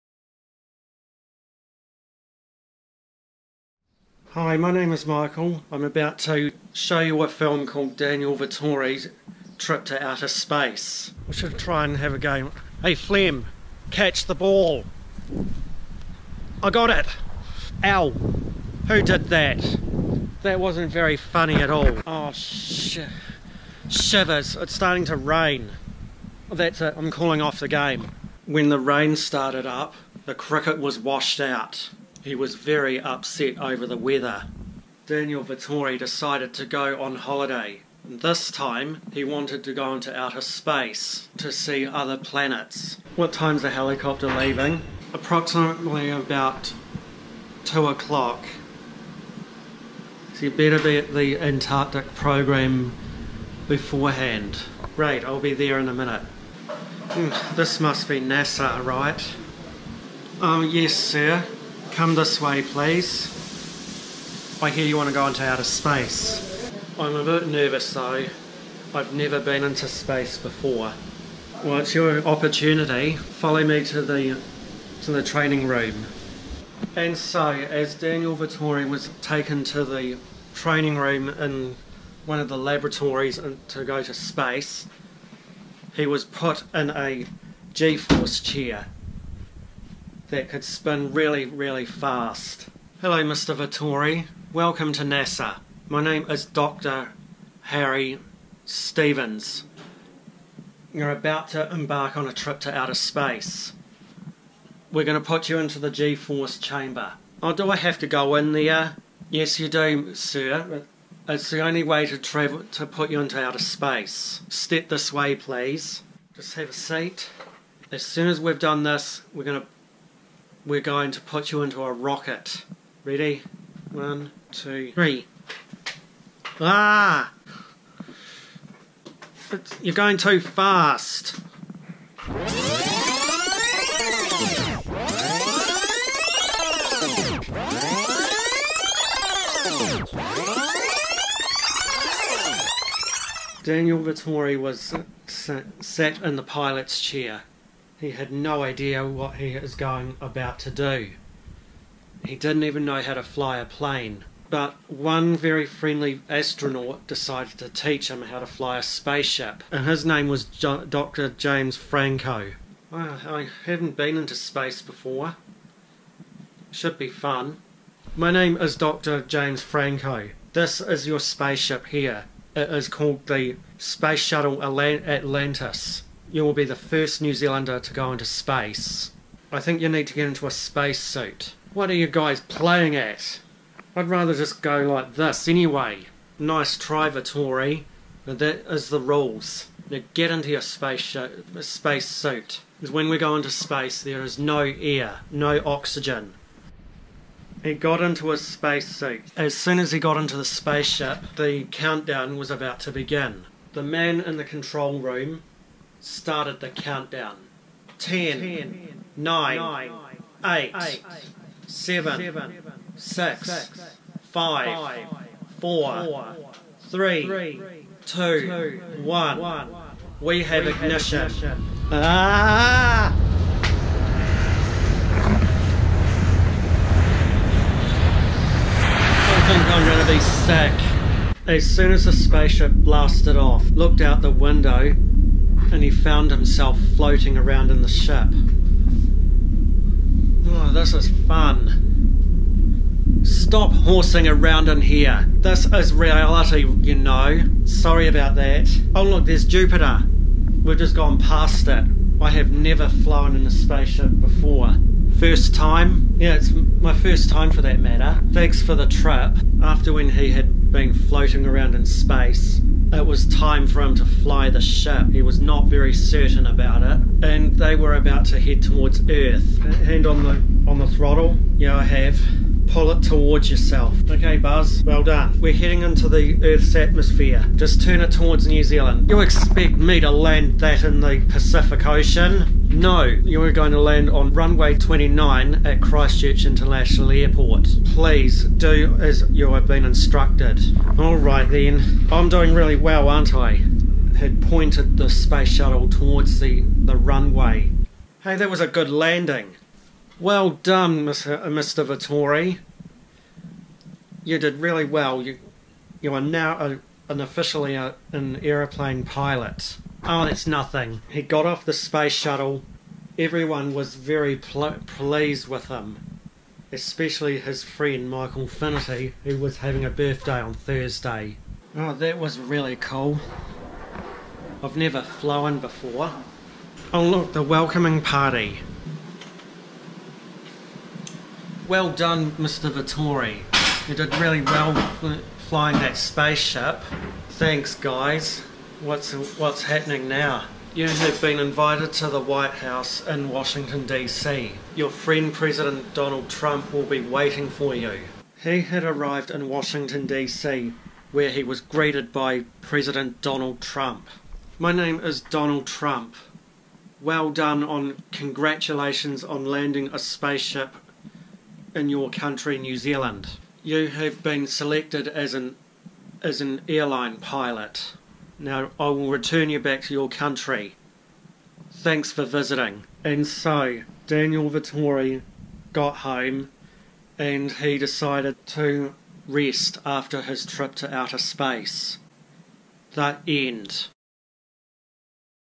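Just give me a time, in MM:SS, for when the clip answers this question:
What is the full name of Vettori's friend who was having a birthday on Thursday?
05:18.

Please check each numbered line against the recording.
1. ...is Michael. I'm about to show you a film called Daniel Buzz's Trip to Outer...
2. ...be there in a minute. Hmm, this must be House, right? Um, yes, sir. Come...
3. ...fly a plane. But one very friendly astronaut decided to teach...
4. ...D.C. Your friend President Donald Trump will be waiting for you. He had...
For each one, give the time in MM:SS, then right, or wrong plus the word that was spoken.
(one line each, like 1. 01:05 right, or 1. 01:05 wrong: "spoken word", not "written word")
1. 00:04 wrong: "Vettori", not "Buzz"
2. 00:55 wrong: "NASA", not "House"
3. 02:33 right
4. 05:43 right.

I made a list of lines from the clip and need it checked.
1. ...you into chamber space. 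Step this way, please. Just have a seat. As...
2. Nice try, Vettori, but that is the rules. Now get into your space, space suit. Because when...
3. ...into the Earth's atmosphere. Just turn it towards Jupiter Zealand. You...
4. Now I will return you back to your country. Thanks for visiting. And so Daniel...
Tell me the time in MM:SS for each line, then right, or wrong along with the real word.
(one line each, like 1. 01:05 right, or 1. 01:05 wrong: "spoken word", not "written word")
1. 01:53 wrong: "outer", not "chamber"
2. 03:06 right
3. 04:35 wrong: "New", not "Jupiter"
4. 06:08 right.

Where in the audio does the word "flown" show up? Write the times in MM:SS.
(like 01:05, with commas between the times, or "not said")
04:12, 05:25.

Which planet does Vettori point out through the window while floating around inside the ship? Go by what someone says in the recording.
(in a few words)
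Jupiter.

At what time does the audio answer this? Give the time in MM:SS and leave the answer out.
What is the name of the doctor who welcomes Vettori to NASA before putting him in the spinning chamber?
01:36.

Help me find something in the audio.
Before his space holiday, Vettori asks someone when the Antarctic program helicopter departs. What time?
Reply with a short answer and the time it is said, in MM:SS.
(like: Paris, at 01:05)
2 o'clock, at 00:47.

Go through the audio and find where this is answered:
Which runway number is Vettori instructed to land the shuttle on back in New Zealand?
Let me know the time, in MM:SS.
04:44.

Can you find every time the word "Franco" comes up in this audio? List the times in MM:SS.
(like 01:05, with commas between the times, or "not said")
02:41, 02:49.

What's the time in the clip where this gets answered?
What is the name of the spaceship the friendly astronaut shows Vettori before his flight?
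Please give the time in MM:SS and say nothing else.
02:53.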